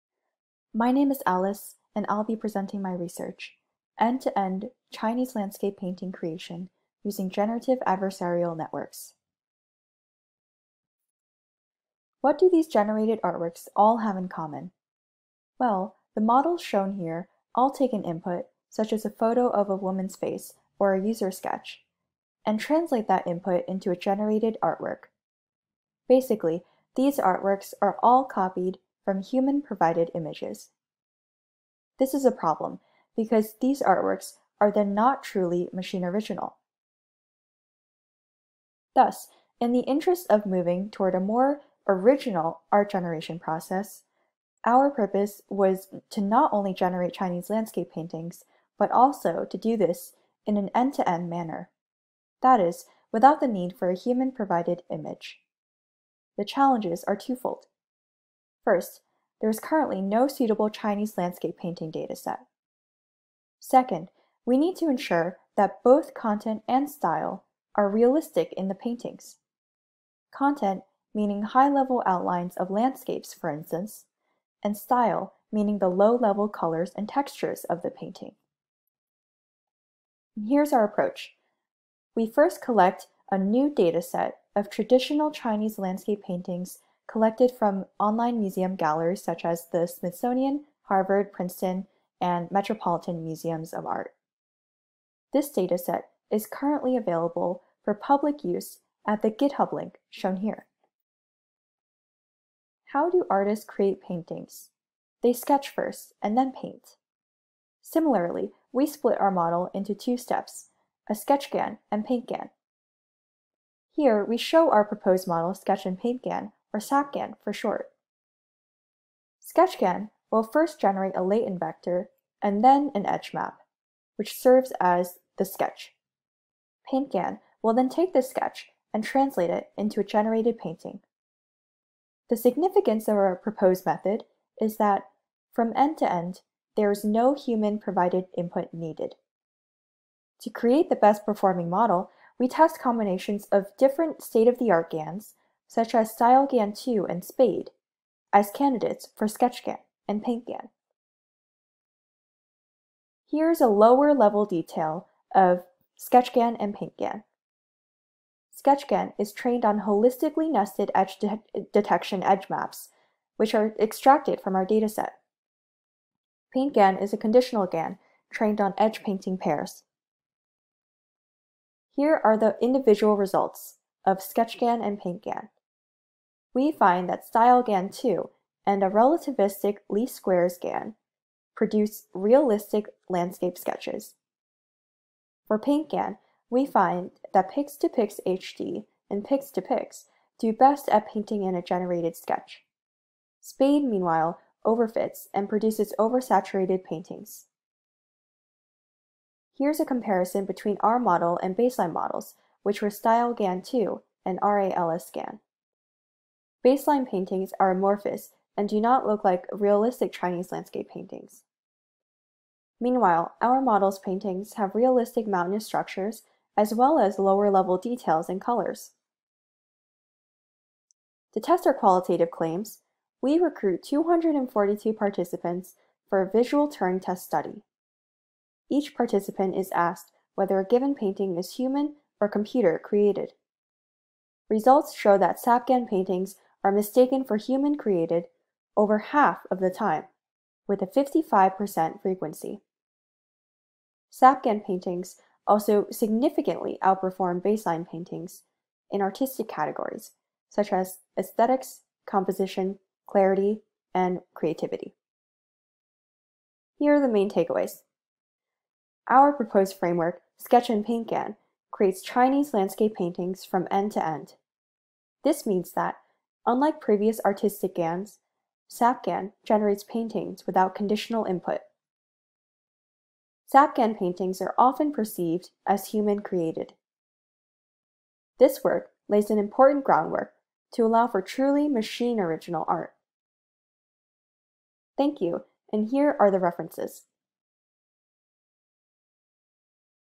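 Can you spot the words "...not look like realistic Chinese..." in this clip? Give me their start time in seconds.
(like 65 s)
208 s.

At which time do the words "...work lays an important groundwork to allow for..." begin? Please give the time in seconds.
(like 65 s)
278 s.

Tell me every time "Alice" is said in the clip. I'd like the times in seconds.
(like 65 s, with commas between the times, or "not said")
1 s.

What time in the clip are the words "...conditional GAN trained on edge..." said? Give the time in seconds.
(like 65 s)
167 s.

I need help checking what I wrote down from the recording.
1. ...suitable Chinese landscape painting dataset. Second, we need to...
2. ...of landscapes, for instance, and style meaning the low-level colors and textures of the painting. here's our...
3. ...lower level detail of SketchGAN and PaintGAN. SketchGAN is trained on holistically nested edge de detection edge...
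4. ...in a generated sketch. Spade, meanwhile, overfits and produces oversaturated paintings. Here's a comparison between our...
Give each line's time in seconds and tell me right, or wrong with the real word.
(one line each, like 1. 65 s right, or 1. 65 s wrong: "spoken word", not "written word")
1. 60 s right
2. 72 s right
3. 153 s right
4. 191 s right.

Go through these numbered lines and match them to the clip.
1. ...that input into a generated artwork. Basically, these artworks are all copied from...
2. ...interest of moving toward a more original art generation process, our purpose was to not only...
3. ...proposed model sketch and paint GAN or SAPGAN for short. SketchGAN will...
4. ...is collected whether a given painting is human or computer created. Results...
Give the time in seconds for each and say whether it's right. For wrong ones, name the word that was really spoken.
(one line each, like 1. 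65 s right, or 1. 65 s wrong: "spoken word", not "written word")
1. 23 s right
2. 39 s right
3. 114 s right
4. 229 s wrong: "asked", not "collected".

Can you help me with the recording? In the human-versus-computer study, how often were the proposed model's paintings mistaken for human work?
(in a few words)
55%.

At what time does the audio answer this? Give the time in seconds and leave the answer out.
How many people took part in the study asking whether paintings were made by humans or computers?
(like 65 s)
223 s.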